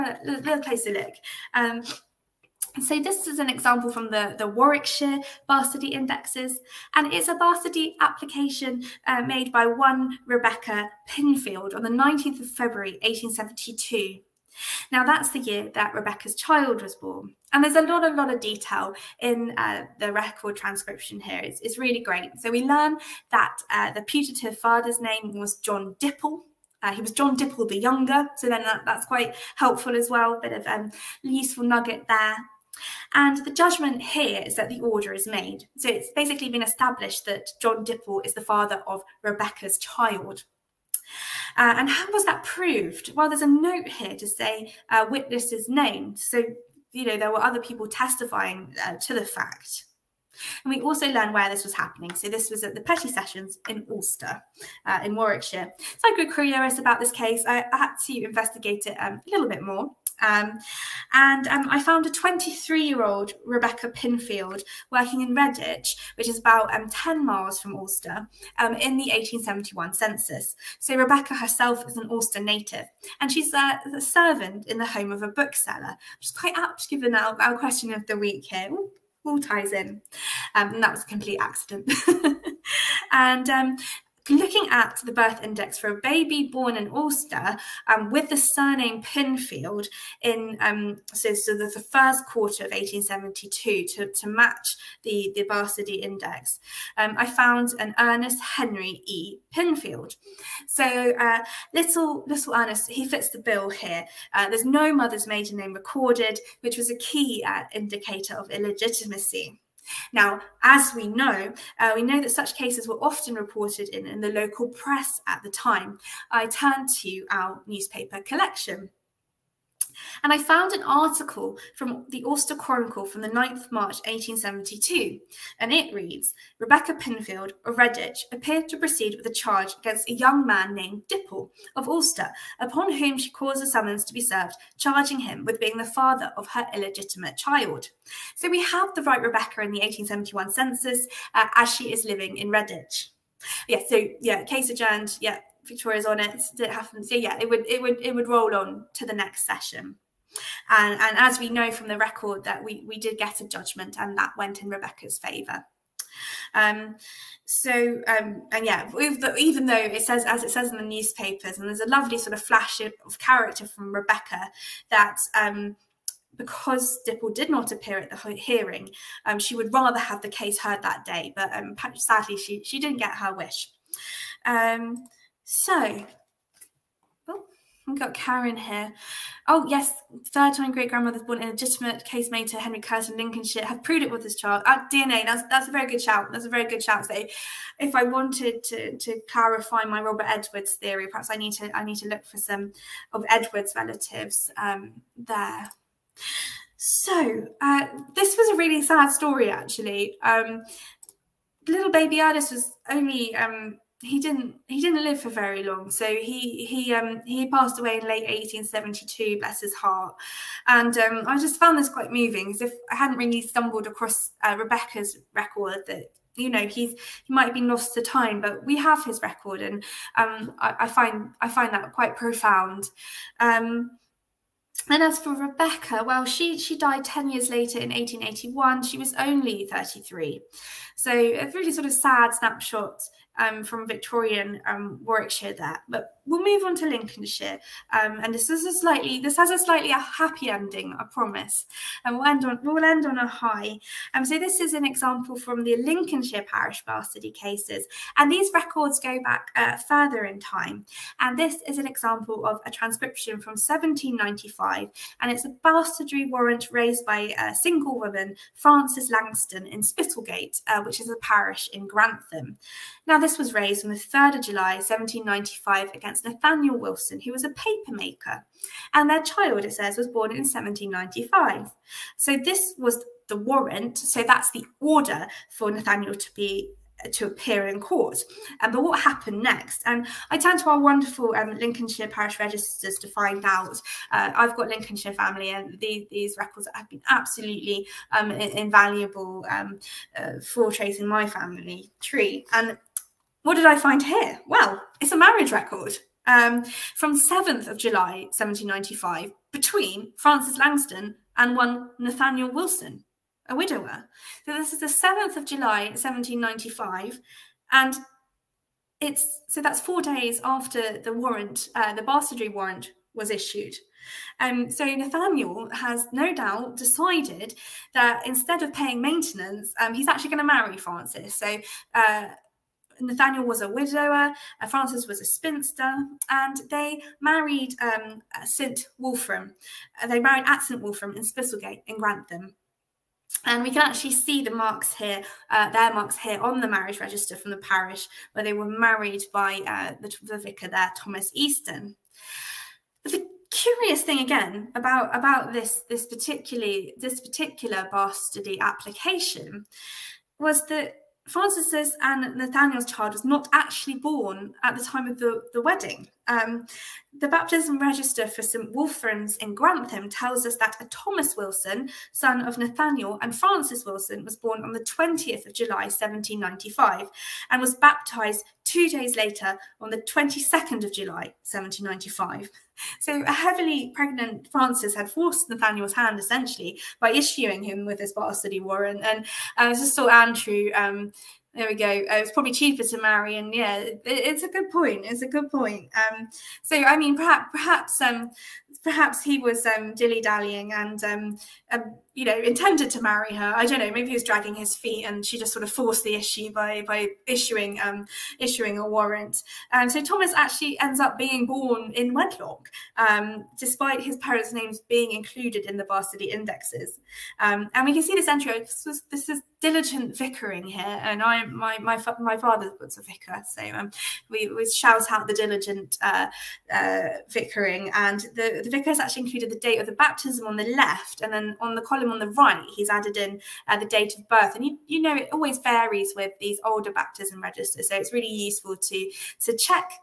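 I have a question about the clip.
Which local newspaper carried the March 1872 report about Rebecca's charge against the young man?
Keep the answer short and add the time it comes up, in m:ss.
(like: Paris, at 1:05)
Alcester Chronicle, at 2:02.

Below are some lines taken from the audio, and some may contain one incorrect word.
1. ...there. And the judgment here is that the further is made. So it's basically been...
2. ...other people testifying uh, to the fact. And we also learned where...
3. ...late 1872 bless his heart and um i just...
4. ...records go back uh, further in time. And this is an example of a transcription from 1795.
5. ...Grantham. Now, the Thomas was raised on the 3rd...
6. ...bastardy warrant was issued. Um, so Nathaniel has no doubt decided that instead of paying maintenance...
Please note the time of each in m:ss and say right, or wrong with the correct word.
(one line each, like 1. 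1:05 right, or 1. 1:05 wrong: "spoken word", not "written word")
1. 0:32 wrong: "order", not "further"
2. 0:47 right
3. 3:28 right
4. 4:08 right
5. 4:21 right
6. 5:12 right.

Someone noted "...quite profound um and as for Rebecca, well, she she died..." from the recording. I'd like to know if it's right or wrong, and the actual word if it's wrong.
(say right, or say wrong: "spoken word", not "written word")
right.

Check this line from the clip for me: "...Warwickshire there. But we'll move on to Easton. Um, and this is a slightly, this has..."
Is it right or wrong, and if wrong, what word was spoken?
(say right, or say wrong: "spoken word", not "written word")
wrong: "Lincolnshire", not "Easton".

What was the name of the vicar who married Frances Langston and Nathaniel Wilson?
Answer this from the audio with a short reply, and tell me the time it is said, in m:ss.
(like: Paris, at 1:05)
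Thomas Easton, at 5:40.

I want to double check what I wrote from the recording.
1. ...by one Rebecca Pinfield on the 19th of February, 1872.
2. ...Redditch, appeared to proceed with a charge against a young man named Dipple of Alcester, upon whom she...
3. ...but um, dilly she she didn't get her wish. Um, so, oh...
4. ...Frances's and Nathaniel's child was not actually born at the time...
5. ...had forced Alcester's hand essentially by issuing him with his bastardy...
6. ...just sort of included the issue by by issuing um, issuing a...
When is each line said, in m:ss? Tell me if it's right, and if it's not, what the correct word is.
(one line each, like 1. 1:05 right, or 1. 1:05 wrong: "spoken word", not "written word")
1. 0:09 right
2. 2:07 right
3. 2:51 wrong: "sadly", not "dilly"
4. 5:51 right
5. 6:14 wrong: "Nathaniel", not "Alcester"
6. 6:35 wrong: "forced", not "included".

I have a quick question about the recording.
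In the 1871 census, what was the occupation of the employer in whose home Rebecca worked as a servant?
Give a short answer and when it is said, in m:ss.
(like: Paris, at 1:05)
bookseller, at 1:15.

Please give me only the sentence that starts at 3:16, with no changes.
So, uh, this was a really sad story, actually.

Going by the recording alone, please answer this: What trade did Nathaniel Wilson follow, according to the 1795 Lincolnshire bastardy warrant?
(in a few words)
papermaker.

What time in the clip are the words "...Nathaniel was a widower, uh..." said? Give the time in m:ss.
5:23.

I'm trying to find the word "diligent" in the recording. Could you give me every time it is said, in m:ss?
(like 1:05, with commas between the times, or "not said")
6:49, 6:55.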